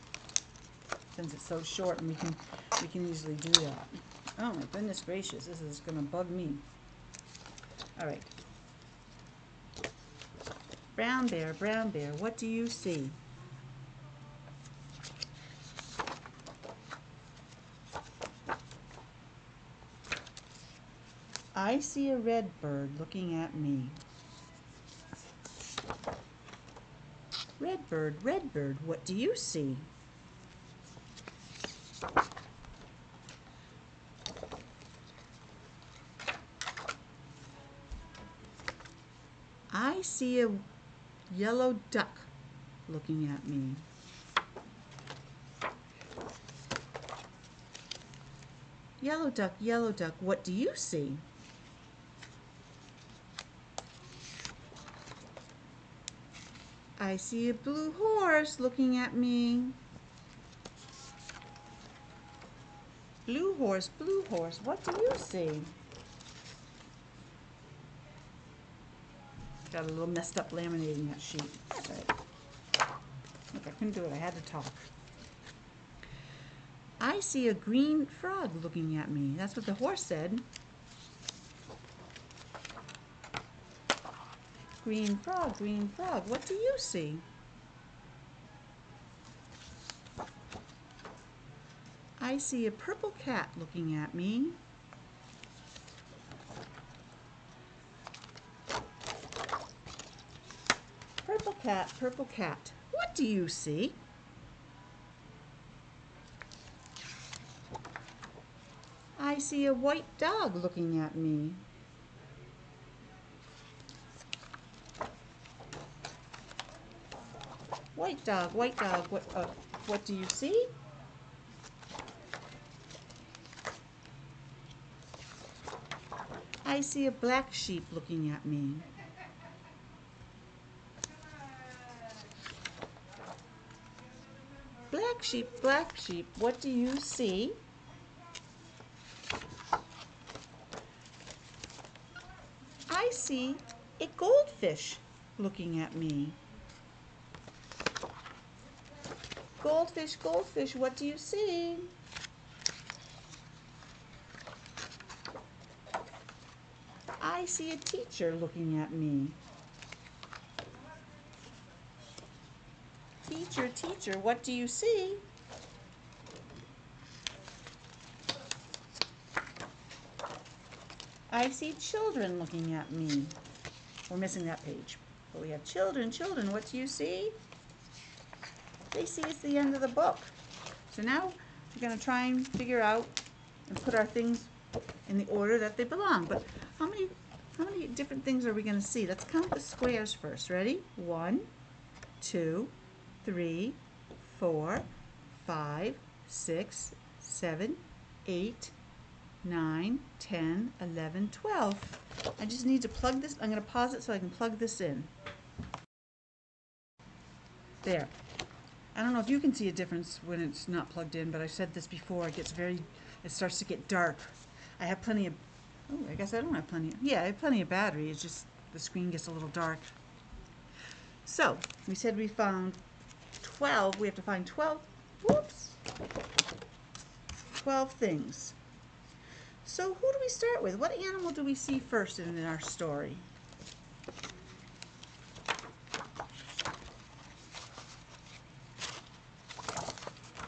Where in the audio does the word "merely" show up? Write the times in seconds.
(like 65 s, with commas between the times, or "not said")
not said.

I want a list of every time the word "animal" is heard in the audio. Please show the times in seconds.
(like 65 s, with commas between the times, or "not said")
230 s.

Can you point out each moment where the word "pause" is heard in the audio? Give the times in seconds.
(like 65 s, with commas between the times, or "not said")
203 s.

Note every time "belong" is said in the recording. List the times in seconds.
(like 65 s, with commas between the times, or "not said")
185 s.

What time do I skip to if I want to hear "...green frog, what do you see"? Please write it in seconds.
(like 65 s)
85 s.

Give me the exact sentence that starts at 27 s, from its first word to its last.
Red bird, red bird, what do you see?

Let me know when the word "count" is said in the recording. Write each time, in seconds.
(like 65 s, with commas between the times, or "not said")
189 s.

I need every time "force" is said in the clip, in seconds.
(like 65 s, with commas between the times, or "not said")
not said.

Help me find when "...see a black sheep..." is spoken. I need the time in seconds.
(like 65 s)
126 s.